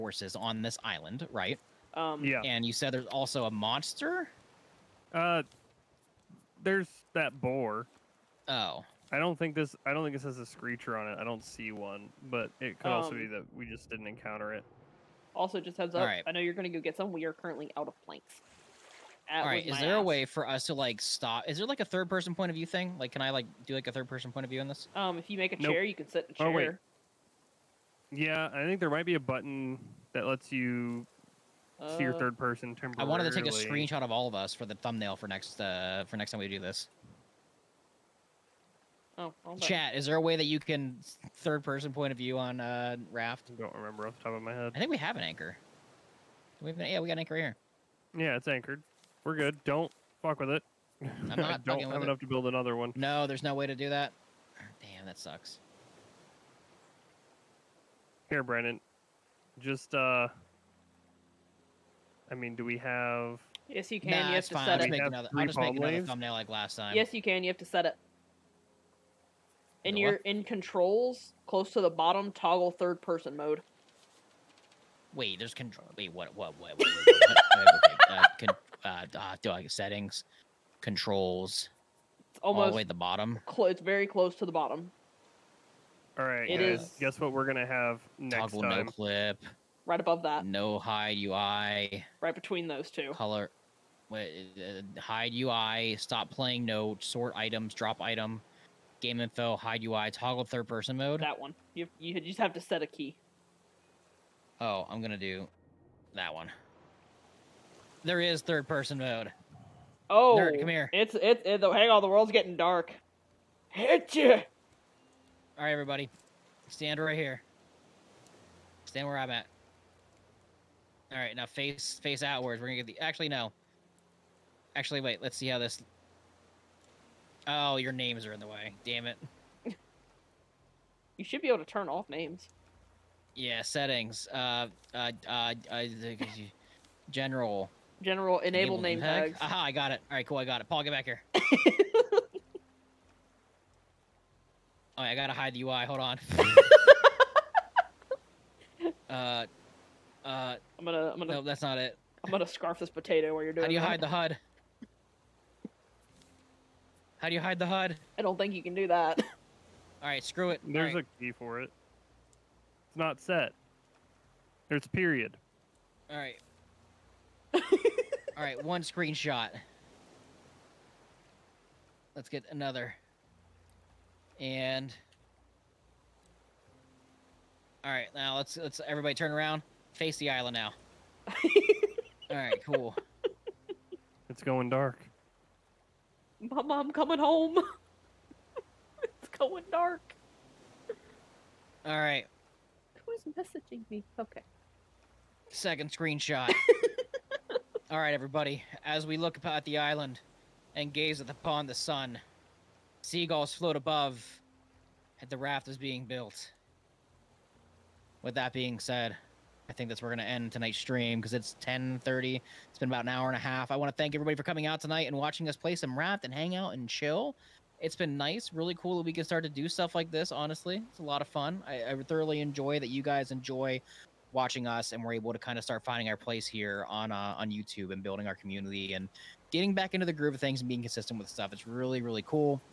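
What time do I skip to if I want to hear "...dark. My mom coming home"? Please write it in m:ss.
3:04.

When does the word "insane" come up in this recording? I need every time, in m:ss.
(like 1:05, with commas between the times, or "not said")
not said.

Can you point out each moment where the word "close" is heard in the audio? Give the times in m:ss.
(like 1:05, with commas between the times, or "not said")
1:11, 1:24.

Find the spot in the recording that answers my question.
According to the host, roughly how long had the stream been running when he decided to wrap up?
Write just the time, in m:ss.
3:32.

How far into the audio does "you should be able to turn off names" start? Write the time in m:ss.
2:11.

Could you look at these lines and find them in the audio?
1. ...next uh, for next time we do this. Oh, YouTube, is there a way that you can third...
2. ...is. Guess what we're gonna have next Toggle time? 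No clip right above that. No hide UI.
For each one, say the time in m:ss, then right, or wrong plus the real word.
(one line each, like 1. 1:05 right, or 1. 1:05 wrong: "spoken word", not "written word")
1. 0:35 wrong: "Chat", not "YouTube"
2. 1:26 right.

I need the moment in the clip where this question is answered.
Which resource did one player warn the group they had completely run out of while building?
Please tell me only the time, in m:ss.
0:18.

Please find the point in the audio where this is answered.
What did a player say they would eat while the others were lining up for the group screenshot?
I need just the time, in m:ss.
2:32.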